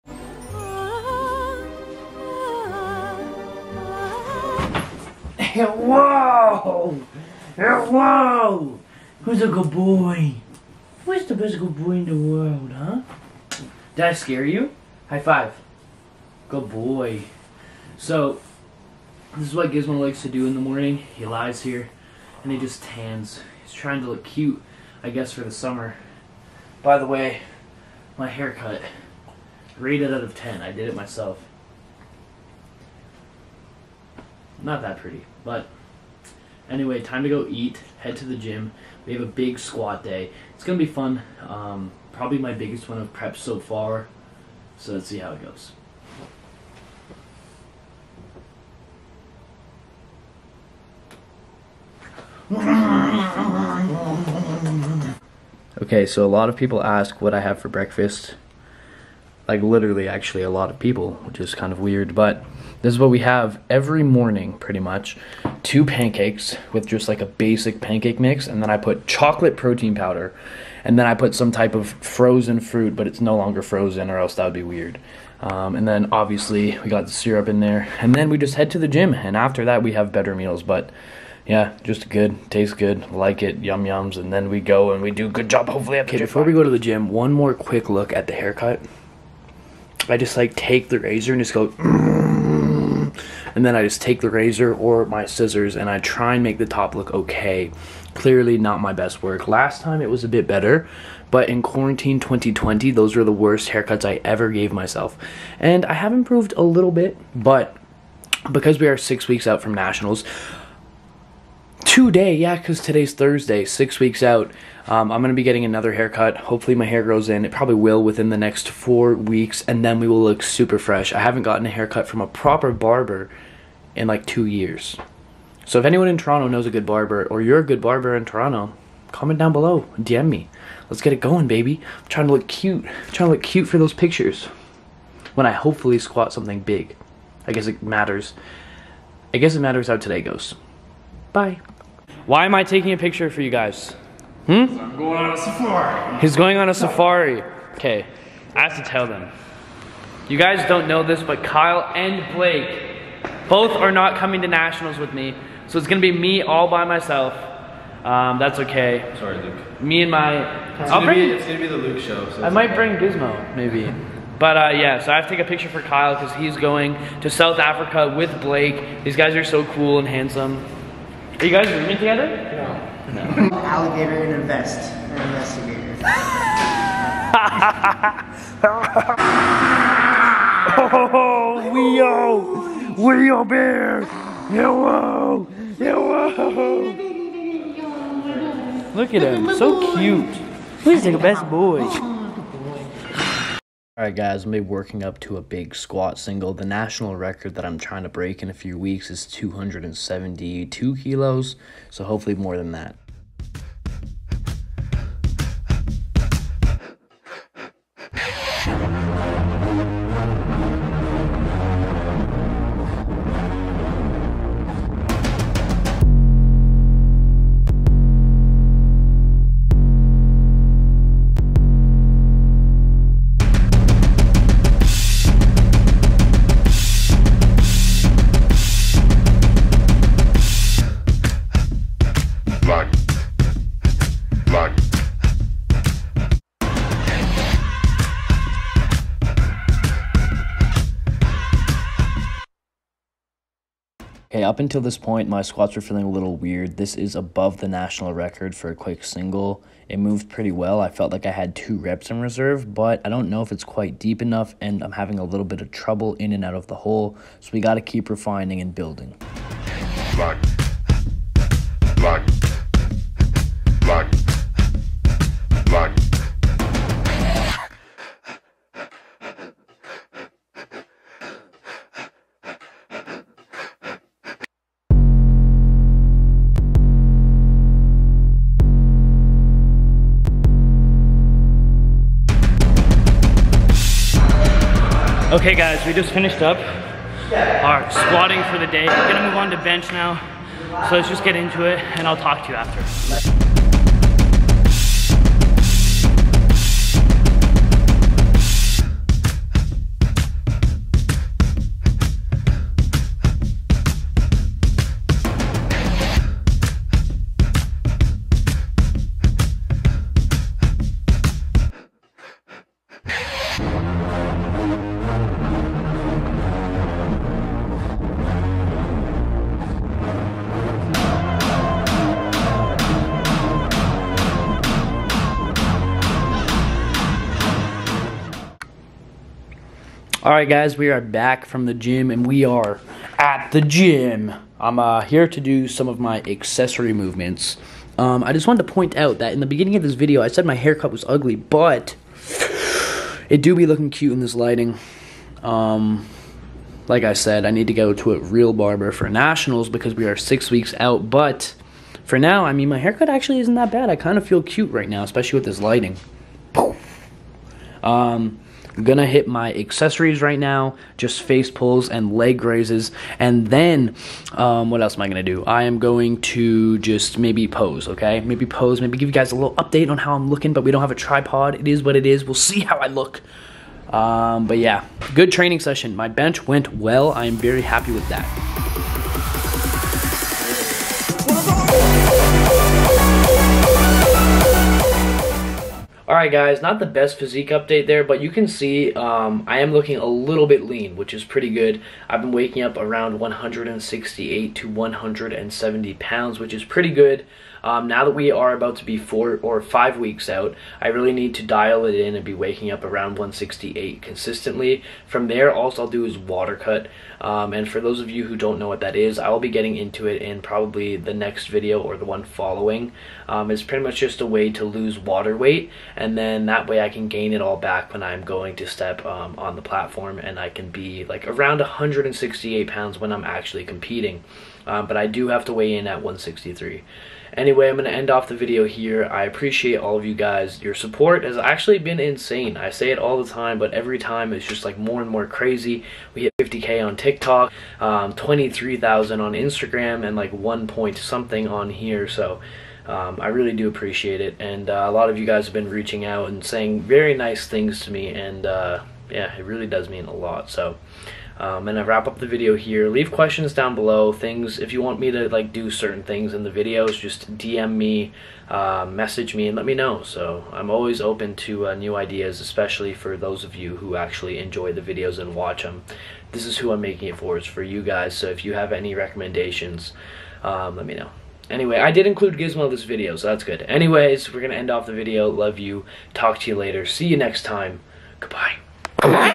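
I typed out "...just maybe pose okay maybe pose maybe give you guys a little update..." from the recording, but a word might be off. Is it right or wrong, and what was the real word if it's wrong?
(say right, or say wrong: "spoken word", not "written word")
right.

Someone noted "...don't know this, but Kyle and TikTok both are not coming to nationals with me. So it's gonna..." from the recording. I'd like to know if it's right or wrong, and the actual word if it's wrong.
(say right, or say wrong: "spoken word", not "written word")
wrong: "Blake", not "TikTok".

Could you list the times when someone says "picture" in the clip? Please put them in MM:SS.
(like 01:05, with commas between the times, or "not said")
02:13, 02:22, 02:45.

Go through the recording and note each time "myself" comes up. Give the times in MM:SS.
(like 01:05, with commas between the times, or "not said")
00:30, 01:44, 02:36.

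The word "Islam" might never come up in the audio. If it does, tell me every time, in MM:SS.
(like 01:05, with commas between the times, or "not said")
not said.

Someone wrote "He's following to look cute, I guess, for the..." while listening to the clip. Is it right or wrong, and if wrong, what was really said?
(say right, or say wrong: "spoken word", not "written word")
wrong: "trying", not "following".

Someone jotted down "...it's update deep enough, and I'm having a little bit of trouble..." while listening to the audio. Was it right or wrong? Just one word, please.
wrong.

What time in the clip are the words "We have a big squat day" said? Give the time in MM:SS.
00:39.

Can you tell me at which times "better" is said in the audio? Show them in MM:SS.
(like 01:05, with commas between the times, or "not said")
01:20, 01:40.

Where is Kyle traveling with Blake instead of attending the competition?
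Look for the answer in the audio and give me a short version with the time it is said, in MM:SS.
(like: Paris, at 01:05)
South Africa, at 02:47.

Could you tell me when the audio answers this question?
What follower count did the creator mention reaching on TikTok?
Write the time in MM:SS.
07:16.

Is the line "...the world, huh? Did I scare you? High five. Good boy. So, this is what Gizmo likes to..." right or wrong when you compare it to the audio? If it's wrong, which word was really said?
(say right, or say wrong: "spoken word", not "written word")
right.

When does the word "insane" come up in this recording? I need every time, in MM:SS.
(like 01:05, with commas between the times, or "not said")
07:11.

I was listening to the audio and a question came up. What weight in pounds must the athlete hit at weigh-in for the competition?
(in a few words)
163.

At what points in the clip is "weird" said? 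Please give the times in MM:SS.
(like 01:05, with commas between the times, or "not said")
01:01, 01:14, 04:06.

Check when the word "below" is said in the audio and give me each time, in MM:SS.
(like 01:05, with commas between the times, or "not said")
02:09, 07:33.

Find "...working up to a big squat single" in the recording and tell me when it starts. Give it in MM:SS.
03:14.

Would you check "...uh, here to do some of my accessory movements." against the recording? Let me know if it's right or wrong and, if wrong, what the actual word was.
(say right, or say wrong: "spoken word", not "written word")
right.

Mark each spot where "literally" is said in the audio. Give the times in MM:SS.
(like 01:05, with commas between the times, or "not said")
00:59.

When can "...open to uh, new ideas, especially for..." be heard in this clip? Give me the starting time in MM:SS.
07:41.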